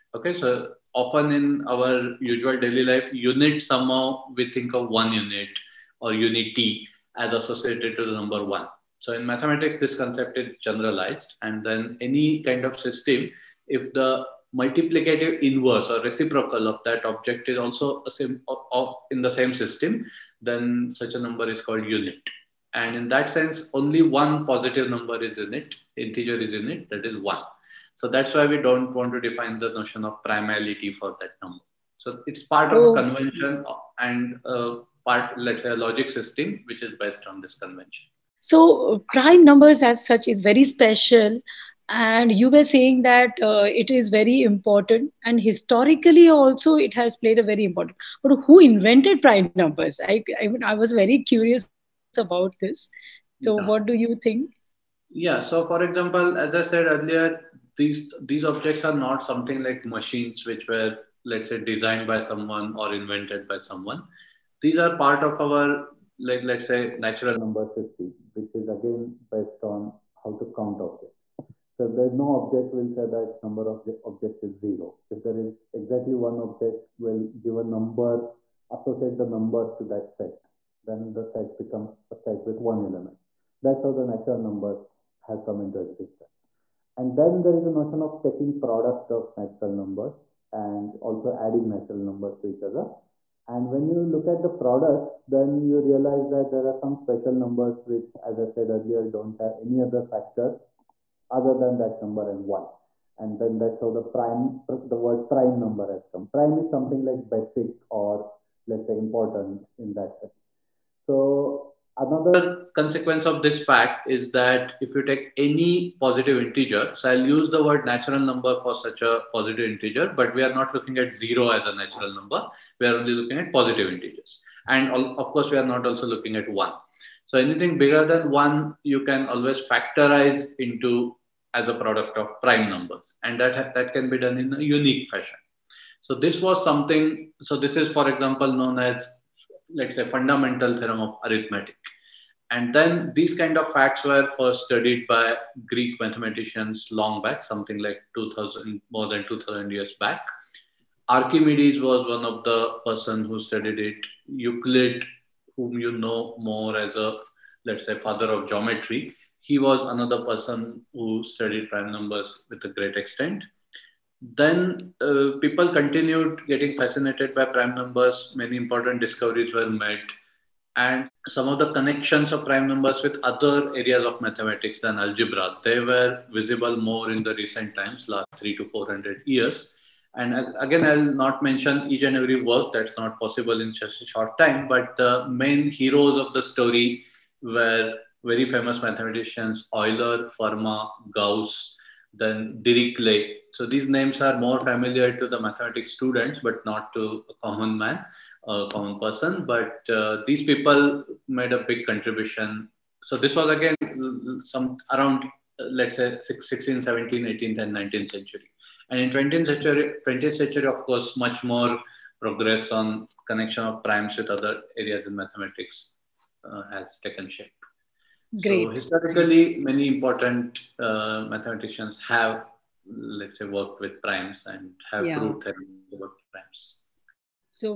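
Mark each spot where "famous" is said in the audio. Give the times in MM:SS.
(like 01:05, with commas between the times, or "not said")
03:08.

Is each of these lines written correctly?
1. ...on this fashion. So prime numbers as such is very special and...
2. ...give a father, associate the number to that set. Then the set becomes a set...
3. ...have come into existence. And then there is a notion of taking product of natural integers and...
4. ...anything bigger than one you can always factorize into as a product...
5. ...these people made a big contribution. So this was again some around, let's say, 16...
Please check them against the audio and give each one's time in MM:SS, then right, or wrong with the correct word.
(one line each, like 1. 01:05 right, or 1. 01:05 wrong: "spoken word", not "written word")
1. 00:37 wrong: "convention", not "fashion"
2. 01:17 wrong: "number", not "father"
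3. 01:25 wrong: "numbers", not "integers"
4. 02:07 right
5. 03:20 right.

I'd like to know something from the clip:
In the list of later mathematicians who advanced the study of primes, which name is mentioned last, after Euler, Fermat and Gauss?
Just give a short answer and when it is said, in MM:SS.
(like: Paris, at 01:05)
Dirichlet, at 03:12.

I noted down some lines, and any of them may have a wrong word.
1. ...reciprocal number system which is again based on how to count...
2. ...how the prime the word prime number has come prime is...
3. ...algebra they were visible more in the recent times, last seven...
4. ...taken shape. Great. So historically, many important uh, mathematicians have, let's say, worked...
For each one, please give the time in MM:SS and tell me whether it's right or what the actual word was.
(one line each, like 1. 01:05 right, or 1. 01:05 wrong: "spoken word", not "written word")
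1. 01:06 wrong: "natural", not "reciprocal"
2. 01:43 right
3. 02:54 wrong: "three", not "seven"
4. 03:37 right.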